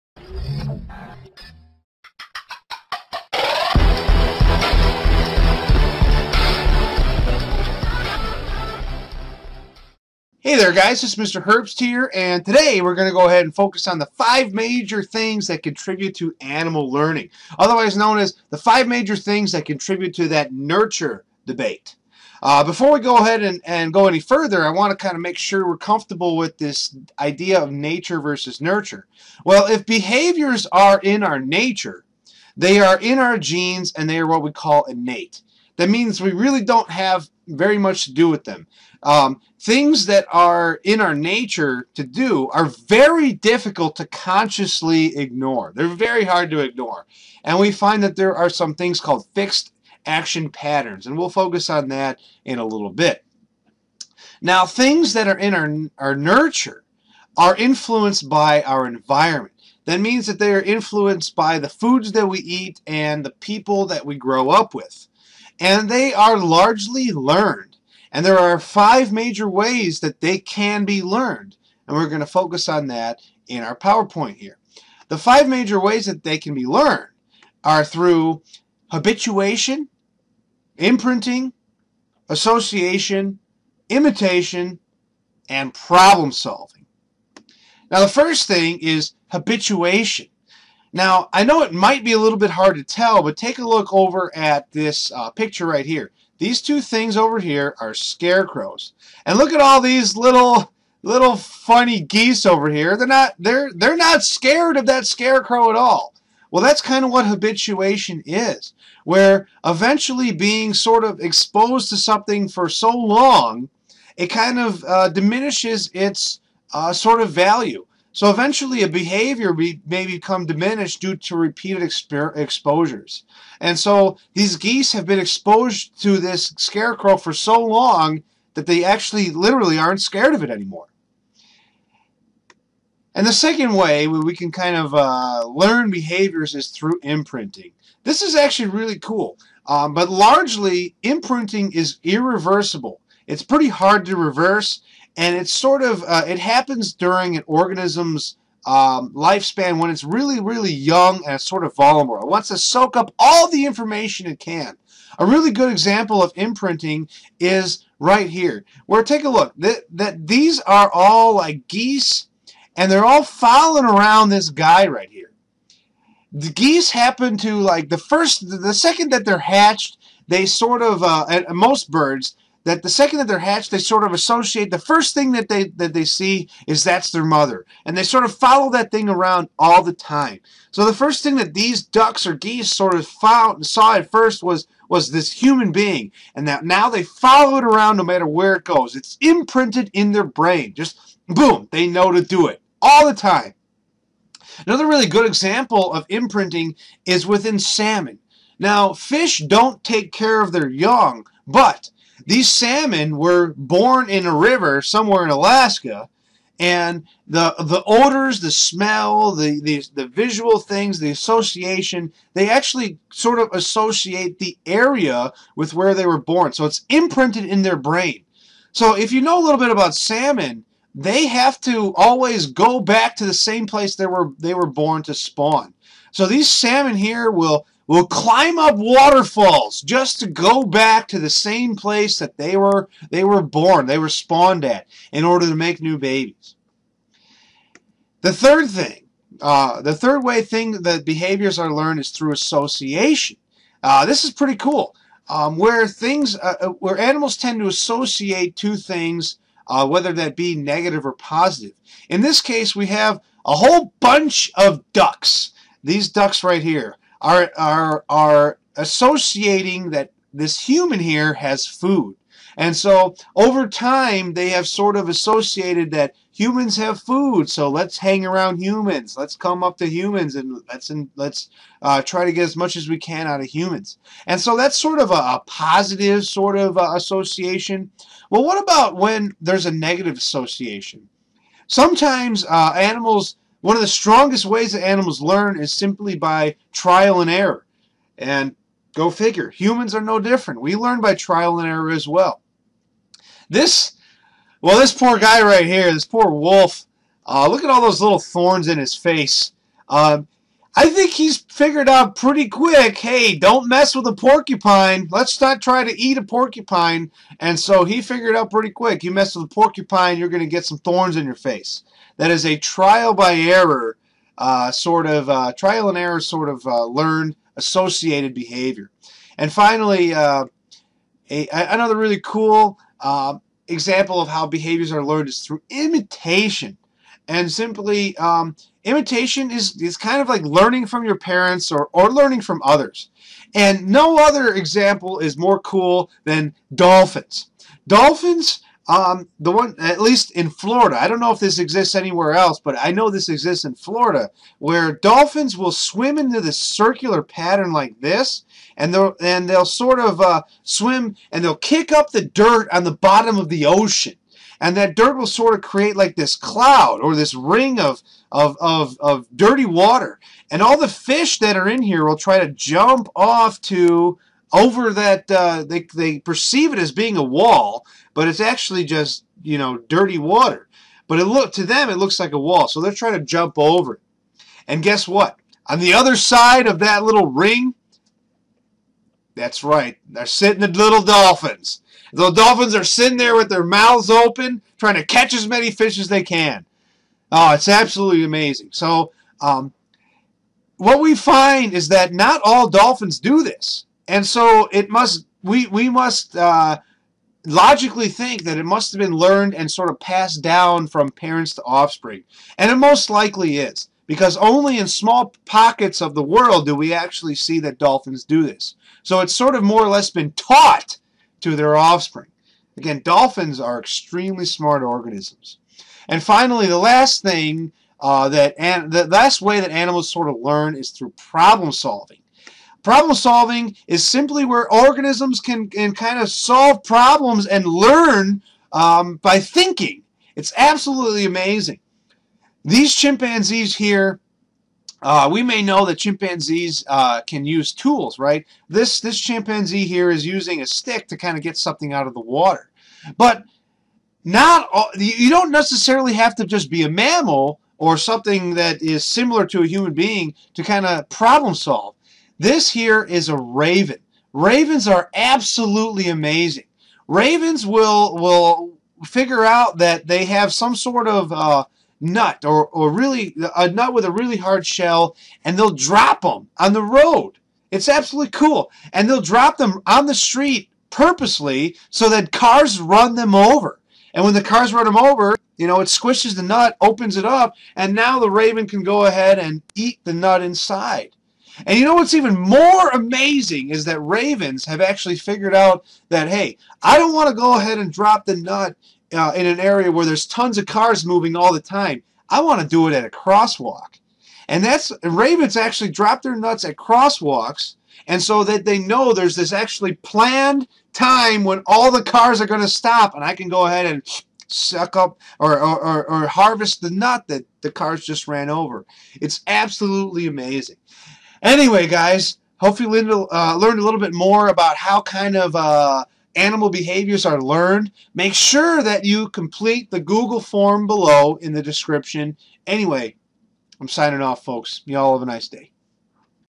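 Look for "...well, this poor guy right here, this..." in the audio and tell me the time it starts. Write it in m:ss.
4:54.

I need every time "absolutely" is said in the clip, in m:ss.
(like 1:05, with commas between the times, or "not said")
6:27, 7:10, 7:35, 7:47, 8:29.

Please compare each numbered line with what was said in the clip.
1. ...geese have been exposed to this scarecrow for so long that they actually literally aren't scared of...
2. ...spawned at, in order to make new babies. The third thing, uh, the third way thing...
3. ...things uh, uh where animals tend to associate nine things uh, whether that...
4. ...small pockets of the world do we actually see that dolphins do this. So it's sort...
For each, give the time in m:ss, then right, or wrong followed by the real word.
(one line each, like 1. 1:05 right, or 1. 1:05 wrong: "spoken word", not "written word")
1. 2:04 right
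2. 3:54 right
3. 4:05 wrong: "two", not "nine"
4. 6:44 right.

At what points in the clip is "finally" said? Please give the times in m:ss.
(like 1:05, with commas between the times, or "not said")
5:19, 6:56.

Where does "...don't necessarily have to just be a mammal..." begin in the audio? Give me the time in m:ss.
7:25.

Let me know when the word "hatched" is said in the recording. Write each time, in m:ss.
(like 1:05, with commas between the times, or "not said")
2:49, 2:53.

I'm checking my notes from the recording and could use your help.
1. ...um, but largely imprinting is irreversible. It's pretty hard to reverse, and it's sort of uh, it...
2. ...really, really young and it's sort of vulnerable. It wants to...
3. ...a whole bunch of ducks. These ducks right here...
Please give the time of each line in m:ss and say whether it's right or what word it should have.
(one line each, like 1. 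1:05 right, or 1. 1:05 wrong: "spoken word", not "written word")
1. 2:19 right
2. 2:30 right
3. 4:13 right.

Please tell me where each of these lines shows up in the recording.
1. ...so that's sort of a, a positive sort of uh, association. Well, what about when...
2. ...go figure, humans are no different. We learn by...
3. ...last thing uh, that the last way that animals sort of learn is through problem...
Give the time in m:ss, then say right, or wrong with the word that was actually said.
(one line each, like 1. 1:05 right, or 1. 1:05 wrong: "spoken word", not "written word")
1. 4:34 right
2. 4:48 right
3. 6:56 right.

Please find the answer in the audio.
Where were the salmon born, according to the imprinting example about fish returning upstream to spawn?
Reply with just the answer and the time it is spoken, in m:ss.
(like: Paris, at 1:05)
Alaska, at 3:25.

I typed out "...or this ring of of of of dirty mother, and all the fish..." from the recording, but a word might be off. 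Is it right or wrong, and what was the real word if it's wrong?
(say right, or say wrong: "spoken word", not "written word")
wrong: "water", not "mother".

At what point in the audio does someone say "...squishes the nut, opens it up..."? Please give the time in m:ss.
7:55.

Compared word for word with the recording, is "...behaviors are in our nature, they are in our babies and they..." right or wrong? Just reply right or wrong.
wrong.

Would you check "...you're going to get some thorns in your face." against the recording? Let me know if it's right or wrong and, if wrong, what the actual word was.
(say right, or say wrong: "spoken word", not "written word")
right.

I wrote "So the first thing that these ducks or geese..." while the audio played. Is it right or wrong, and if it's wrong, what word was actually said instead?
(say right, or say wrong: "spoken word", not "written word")
right.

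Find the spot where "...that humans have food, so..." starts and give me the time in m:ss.
4:25.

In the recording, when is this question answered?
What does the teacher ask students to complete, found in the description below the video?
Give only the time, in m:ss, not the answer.
8:39.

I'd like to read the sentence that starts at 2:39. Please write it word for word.
That, that these are all like geese and they're all following around this guy right here.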